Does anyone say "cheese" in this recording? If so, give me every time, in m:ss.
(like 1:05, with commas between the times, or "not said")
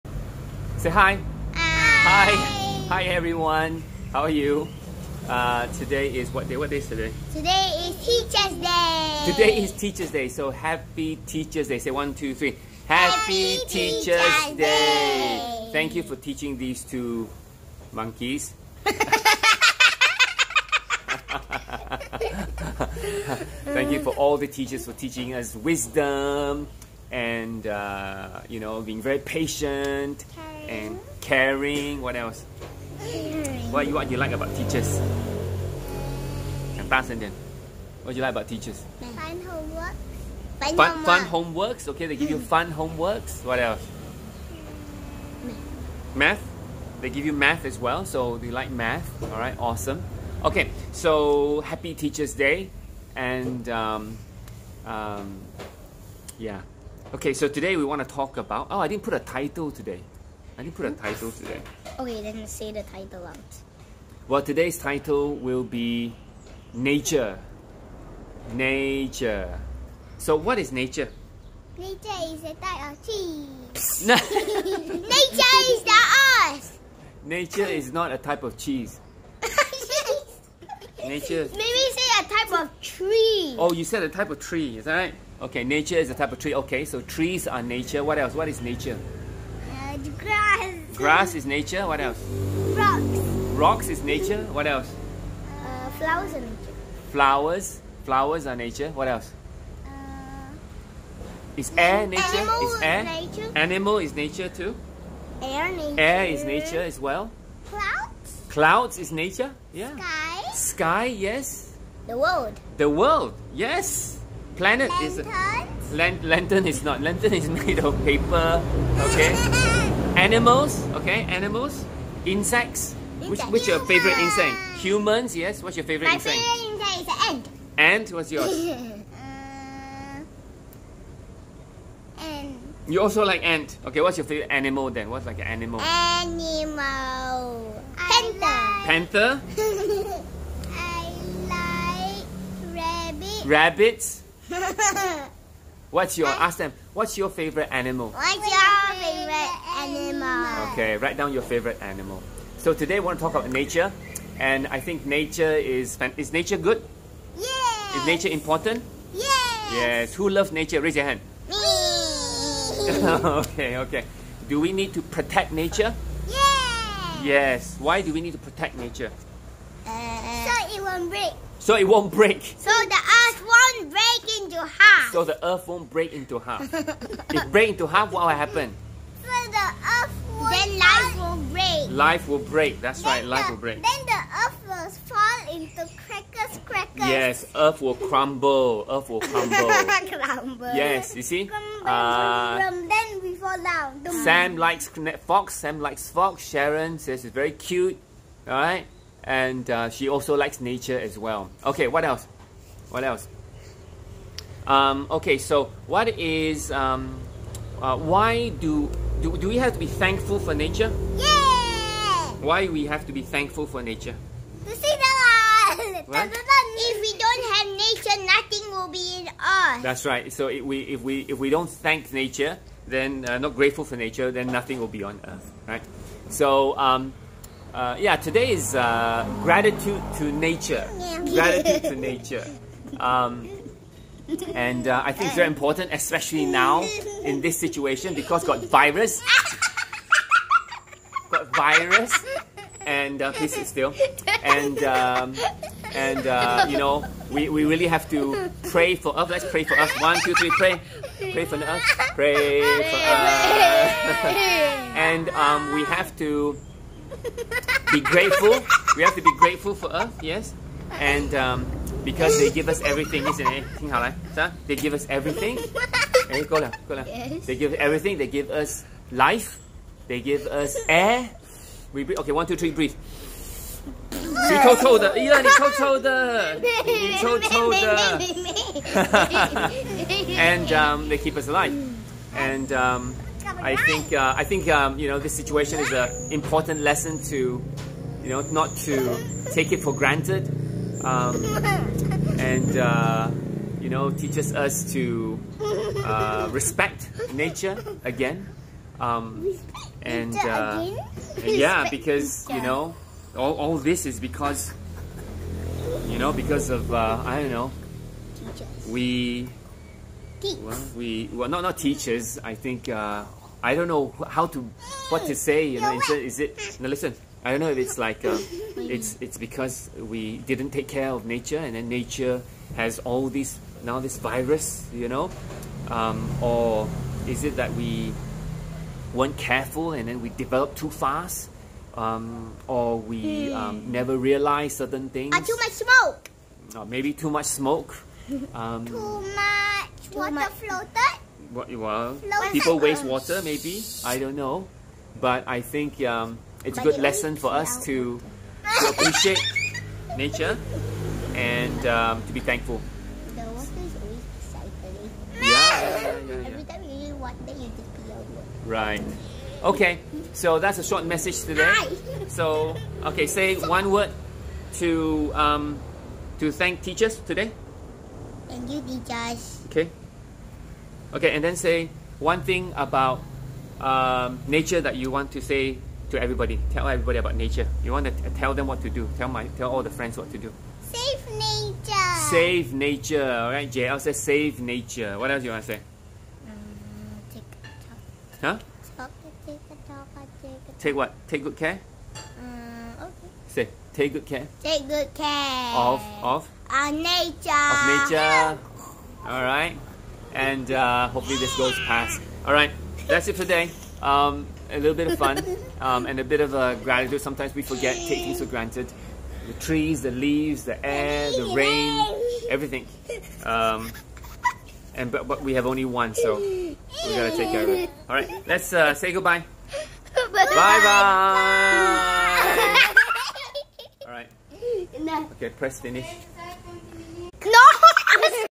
1:13, 1:18.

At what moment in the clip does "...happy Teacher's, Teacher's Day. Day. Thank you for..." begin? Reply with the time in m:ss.
0:13.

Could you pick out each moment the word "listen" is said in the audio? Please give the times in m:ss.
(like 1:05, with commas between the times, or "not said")
5:16.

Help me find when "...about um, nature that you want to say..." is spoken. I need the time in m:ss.
6:12.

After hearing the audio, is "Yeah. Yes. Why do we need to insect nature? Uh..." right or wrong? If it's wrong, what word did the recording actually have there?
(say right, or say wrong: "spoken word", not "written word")
wrong: "protect", not "insect".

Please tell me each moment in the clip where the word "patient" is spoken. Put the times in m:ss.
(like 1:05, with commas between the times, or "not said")
0:29.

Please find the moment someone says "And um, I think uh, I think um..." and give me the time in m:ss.
4:42.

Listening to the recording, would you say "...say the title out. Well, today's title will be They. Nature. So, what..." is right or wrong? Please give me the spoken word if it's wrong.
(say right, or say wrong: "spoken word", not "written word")
wrong: "Nature", not "They".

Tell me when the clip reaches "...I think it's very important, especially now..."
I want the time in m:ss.
3:55.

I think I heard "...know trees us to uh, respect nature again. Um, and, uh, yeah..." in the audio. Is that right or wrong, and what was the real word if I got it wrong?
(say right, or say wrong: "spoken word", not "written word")
wrong: "teaches", not "trees".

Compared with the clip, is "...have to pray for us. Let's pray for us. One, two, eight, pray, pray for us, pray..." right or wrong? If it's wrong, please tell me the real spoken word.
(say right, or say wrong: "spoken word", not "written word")
wrong: "three", not "eight".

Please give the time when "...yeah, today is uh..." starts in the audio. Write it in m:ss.
3:47.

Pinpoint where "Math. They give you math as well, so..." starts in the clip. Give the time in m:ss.
0:46.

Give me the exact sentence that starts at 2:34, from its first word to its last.
And I think nature is, is nature good?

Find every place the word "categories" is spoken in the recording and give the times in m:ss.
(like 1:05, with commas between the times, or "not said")
not said.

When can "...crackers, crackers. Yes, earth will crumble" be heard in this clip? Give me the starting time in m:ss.
3:06.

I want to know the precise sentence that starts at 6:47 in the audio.
Sometimes we forget, taking for granted.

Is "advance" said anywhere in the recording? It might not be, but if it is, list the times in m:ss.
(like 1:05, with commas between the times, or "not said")
not said.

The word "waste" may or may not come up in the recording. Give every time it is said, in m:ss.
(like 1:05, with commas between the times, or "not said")
5:42.